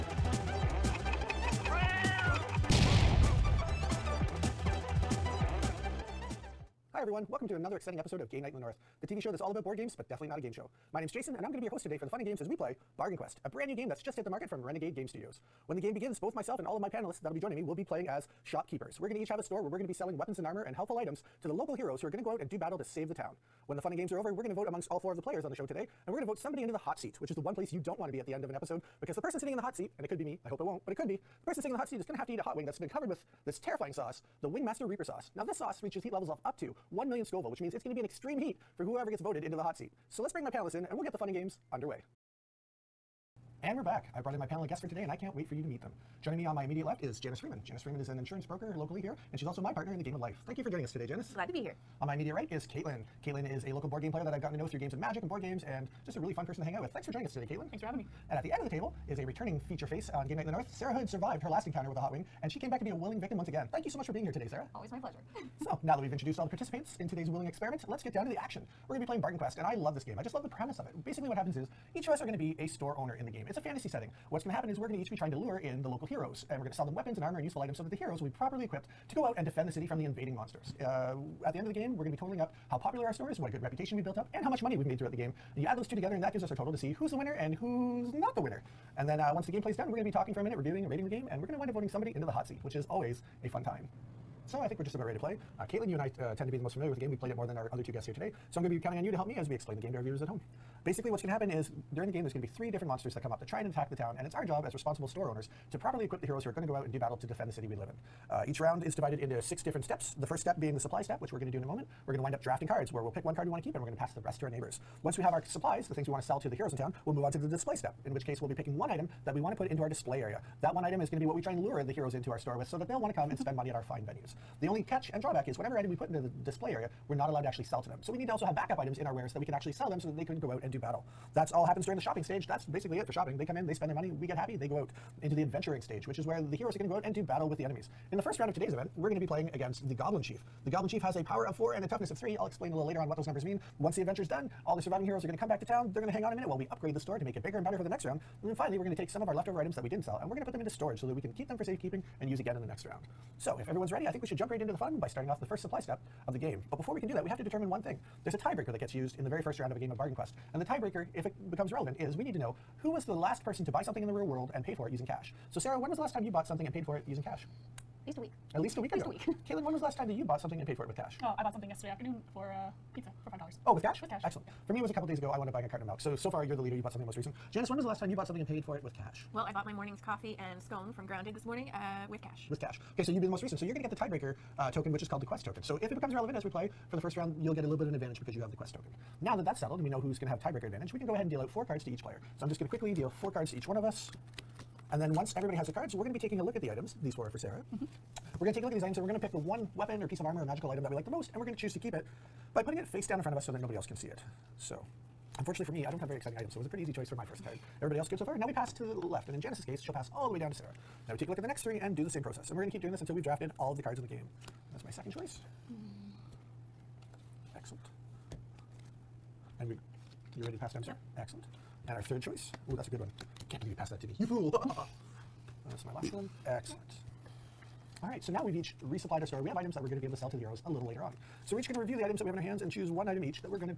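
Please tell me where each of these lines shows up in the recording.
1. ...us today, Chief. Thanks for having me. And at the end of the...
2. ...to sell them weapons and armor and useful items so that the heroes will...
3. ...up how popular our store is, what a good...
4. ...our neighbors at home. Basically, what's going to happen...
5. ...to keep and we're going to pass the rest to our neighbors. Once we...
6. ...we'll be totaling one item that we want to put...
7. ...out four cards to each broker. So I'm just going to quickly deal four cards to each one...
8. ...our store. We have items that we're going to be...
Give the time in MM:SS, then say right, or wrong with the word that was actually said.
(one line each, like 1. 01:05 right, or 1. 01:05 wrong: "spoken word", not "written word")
1. 00:57 wrong: "Caitlin", not "Chief"
2. 01:16 right
3. 01:22 right
4. 01:39 wrong: "viewers", not "neighbors"
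5. 01:53 right
6. 01:58 wrong: "picking", not "totaling"
7. 03:11 wrong: "player", not "broker"
8. 03:49 right.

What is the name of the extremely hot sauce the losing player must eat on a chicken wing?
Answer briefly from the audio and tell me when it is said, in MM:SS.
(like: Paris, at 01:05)
Wingmaster Reaper sauce, at 00:34.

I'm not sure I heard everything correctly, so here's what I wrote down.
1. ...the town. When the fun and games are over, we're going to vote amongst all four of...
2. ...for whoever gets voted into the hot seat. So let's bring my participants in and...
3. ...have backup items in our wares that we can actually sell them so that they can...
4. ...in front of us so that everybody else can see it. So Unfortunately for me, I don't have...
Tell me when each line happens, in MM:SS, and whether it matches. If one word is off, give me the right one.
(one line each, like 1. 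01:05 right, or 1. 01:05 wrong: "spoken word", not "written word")
1. 00:23 right
2. 00:38 wrong: "panelists", not "participants"
3. 02:08 right
4. 03:23 wrong: "nobody", not "everybody".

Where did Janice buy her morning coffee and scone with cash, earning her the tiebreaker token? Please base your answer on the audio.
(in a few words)
Grounded.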